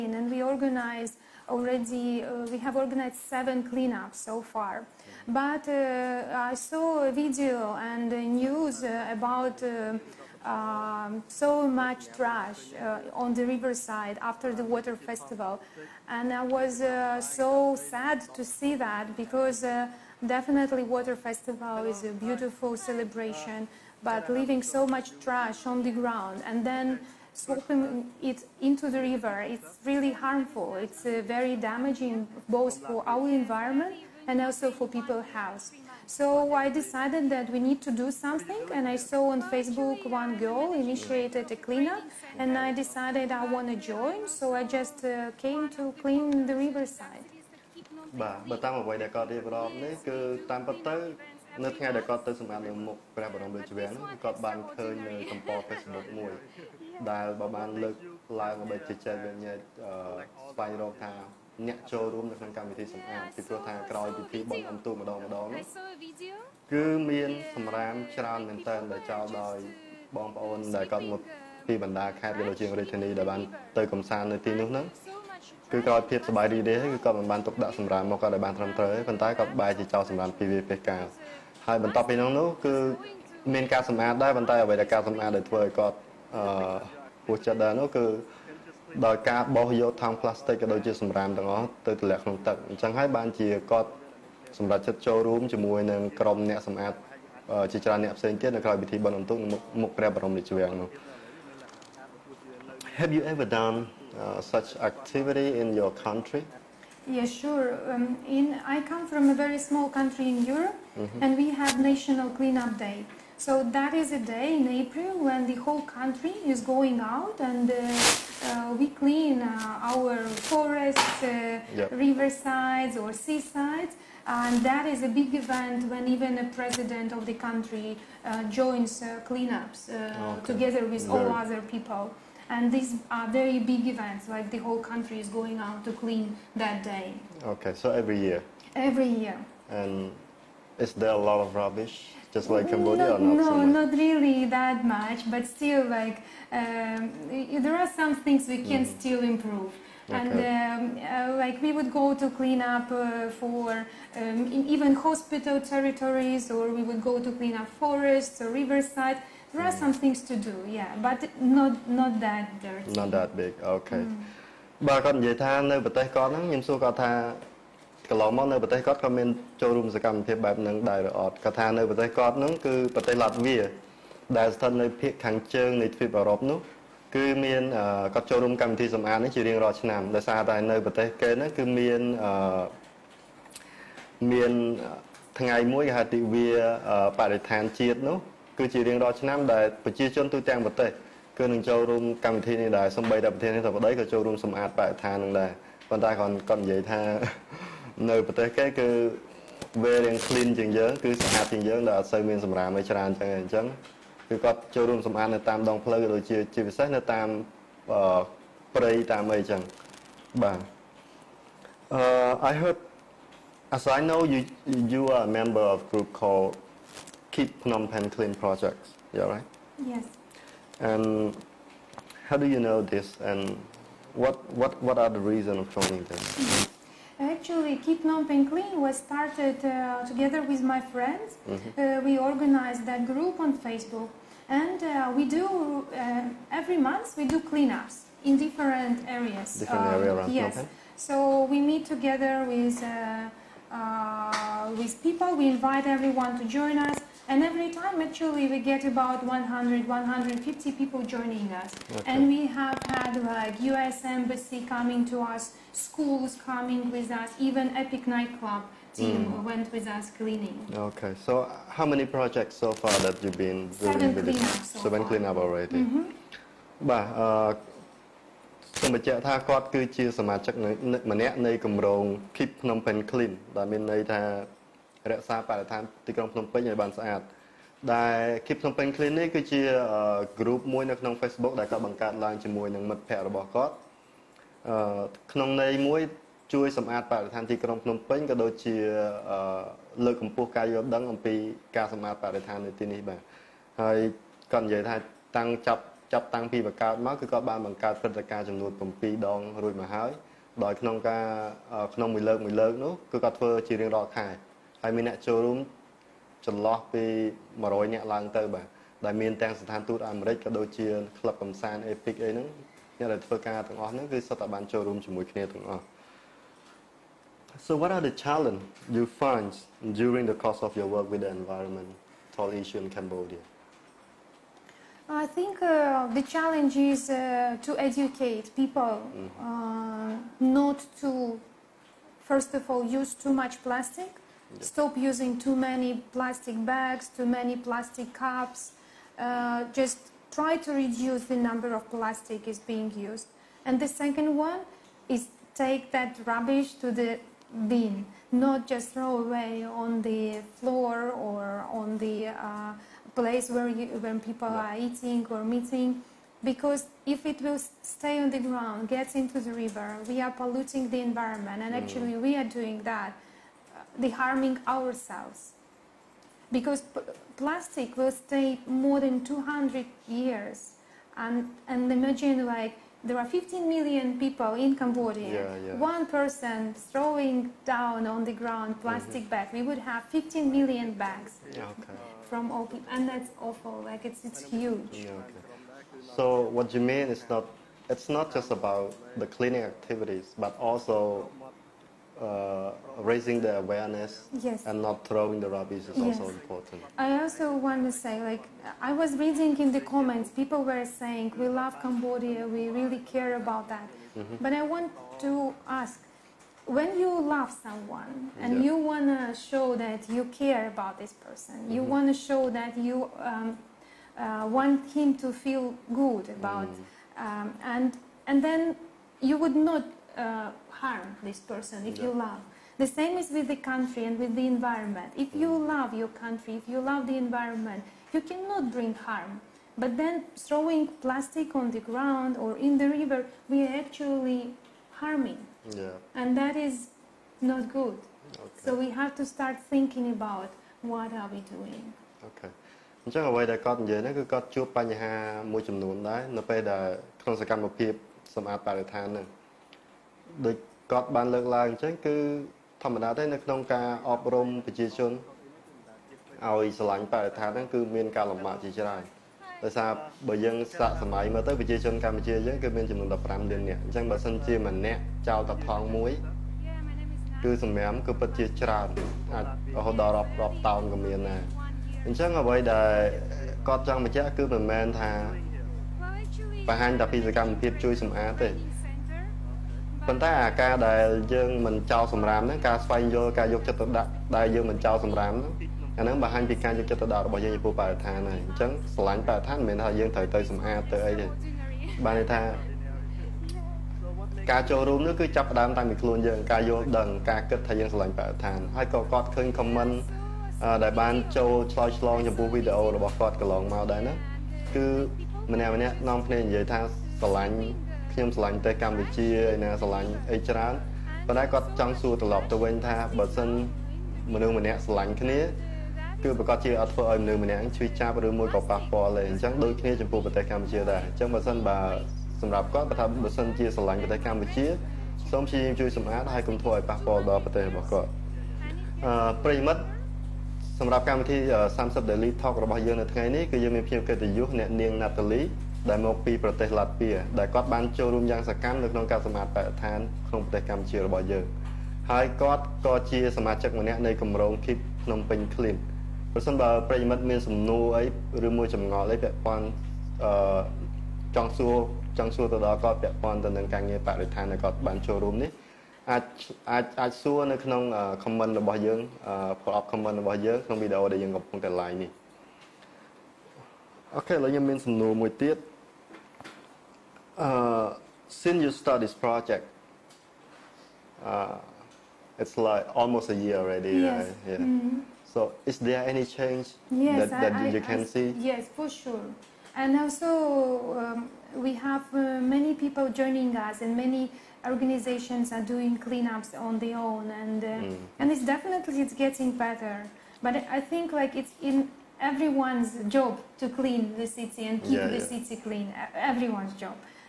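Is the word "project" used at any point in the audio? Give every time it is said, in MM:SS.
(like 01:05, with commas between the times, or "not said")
03:38, 04:22, 09:29.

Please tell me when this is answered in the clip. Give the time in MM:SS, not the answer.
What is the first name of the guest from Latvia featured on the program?
08:55.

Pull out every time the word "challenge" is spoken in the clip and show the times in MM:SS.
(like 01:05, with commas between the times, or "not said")
05:18, 05:26.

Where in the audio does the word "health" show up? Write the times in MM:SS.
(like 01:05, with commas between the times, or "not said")
00:35.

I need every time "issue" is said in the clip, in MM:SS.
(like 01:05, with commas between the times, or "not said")
05:22.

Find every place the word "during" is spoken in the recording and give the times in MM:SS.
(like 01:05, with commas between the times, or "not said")
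05:20.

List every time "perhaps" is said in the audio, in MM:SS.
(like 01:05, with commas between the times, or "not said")
not said.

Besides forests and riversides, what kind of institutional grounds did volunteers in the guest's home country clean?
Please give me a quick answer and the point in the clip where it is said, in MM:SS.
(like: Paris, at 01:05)
hospital territories, at 02:34.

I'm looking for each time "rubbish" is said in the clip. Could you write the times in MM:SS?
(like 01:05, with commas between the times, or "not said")
02:21, 05:46, 06:35.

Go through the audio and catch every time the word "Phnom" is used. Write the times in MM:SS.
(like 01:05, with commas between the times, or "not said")
03:37, 03:48, 04:32, 04:38, 09:05.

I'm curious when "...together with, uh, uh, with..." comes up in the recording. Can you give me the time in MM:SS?
04:01.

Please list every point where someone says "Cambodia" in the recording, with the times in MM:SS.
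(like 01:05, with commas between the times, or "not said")
02:22, 05:22, 06:14, 06:41.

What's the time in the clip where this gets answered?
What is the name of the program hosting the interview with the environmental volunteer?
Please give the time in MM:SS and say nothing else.
08:51.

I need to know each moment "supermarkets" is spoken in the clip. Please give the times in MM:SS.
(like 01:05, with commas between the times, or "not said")
not said.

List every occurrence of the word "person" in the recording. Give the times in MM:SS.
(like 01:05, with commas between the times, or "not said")
06:16, 06:51, 07:01.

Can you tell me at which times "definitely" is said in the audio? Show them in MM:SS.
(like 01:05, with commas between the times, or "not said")
00:20, 09:48.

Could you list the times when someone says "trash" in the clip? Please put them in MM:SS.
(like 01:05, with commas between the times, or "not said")
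00:12, 00:25.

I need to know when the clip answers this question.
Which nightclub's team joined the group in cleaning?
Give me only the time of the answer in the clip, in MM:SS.
04:17.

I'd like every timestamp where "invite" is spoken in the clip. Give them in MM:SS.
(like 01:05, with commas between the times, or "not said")
04:05.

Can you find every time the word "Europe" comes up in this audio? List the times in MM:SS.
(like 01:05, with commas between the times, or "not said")
01:50.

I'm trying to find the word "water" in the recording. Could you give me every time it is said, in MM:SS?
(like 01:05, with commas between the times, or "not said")
00:14, 00:20.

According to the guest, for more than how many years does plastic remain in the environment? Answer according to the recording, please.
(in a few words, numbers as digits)
200.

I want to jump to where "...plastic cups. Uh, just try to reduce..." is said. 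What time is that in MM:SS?
05:37.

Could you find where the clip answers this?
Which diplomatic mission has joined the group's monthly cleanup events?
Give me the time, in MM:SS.
04:13.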